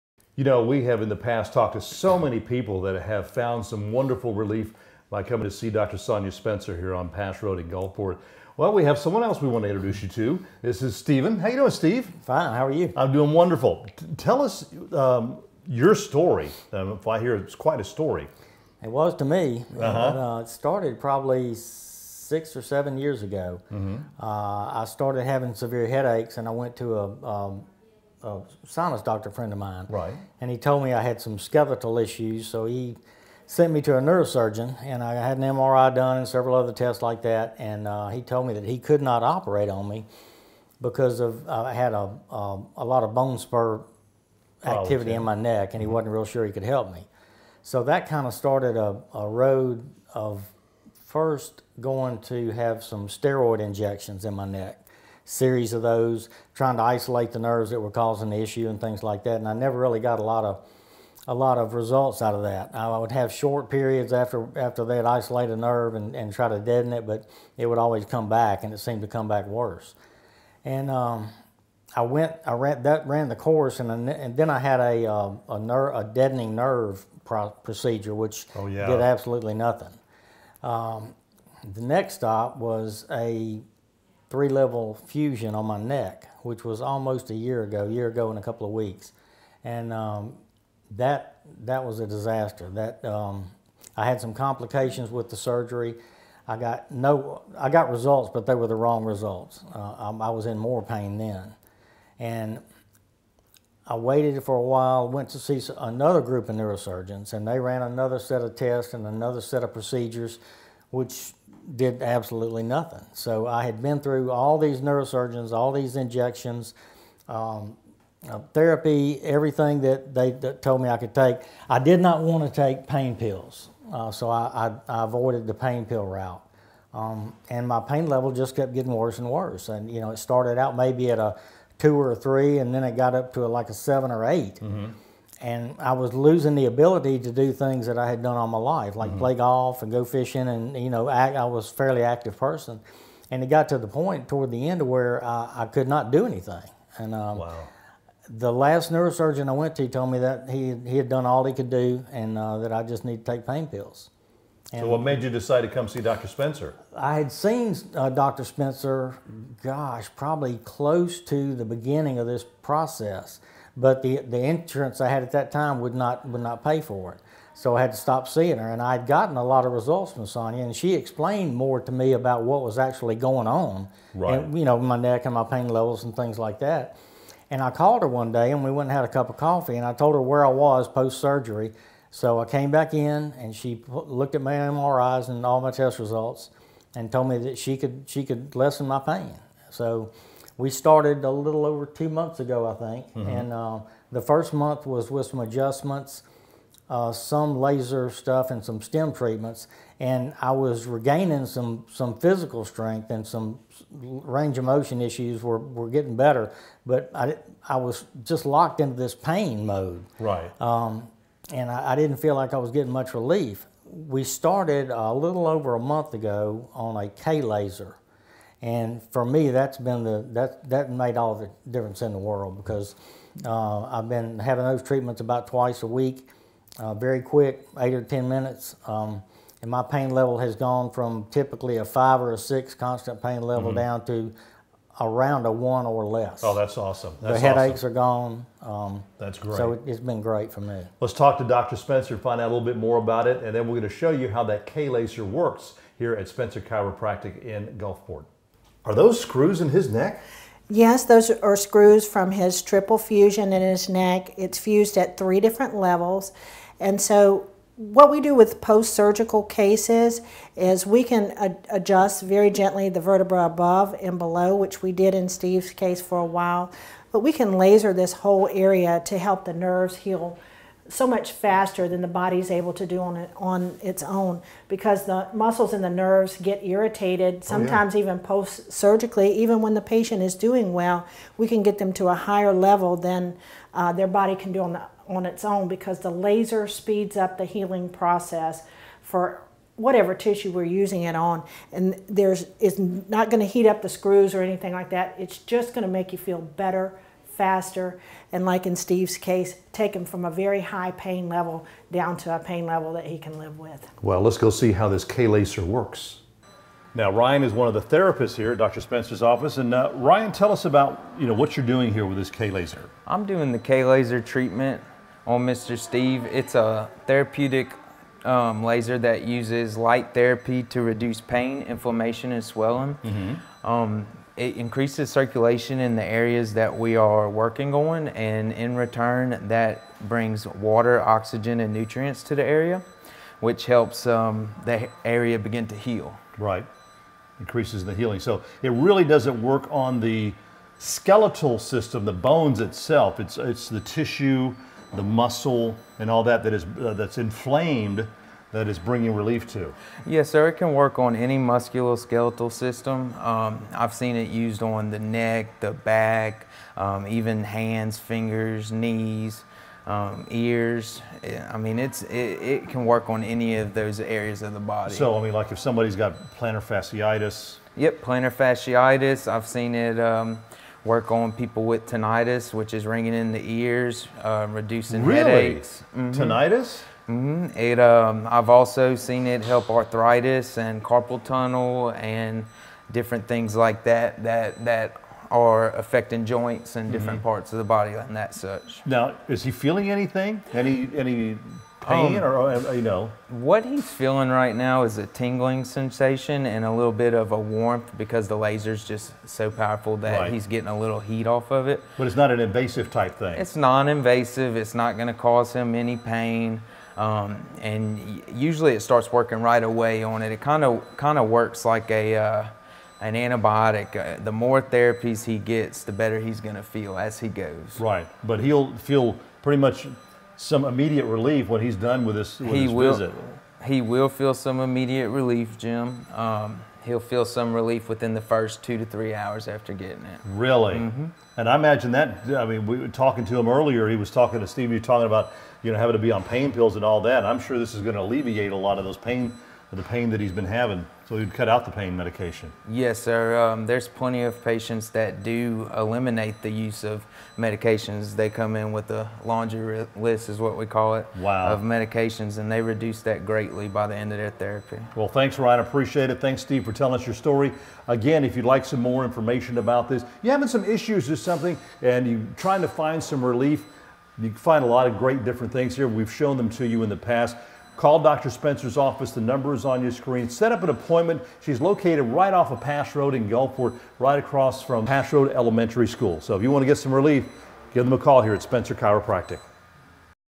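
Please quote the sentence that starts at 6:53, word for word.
Uh, the more therapies he gets, the better he's going to feel as he goes.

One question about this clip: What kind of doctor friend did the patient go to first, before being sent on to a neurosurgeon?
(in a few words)
sinus doctor.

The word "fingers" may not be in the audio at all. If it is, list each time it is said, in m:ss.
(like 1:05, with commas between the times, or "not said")
5:57.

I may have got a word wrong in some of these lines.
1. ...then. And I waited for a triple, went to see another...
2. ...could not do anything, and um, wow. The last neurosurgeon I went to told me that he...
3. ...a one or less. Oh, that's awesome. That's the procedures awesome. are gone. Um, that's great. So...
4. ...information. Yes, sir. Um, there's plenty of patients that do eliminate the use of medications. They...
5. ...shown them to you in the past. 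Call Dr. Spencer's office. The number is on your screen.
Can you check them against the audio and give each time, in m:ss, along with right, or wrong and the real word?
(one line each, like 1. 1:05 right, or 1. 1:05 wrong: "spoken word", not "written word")
1. 1:41 wrong: "while", not "triple"
2. 2:25 right
3. 3:55 wrong: "headaches", not "procedures"
4. 7:21 wrong: "medication", not "information"
5. 7:46 right.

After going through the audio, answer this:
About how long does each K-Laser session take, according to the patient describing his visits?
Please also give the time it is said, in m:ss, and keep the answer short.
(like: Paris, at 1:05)
8 or 10 minutes, at 3:47.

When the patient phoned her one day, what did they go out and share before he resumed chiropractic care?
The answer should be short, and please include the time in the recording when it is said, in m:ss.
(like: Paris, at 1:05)
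a cup of coffee, at 2:59.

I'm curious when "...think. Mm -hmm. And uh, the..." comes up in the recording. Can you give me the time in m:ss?
3:12.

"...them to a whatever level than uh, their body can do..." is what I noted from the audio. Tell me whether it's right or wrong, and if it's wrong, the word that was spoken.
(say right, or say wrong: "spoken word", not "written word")
wrong: "higher", not "whatever".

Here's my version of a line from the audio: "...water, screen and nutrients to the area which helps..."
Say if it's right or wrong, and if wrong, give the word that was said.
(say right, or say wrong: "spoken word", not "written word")
wrong: "oxygen", not "screen".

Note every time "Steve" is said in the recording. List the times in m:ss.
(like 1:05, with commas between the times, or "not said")
0:11, 4:25, 4:58, 5:15, 7:14, 7:36.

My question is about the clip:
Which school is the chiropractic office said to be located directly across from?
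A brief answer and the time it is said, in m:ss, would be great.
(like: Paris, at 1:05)
Pass Road Elementary School, at 7:54.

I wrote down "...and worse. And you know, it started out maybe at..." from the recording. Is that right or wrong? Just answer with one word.
right.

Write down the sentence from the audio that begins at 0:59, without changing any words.
And I never really got a lot of a lot of results out of that.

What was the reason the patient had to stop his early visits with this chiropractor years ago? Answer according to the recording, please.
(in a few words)
insurance.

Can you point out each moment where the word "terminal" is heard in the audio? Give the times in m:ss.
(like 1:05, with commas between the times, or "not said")
not said.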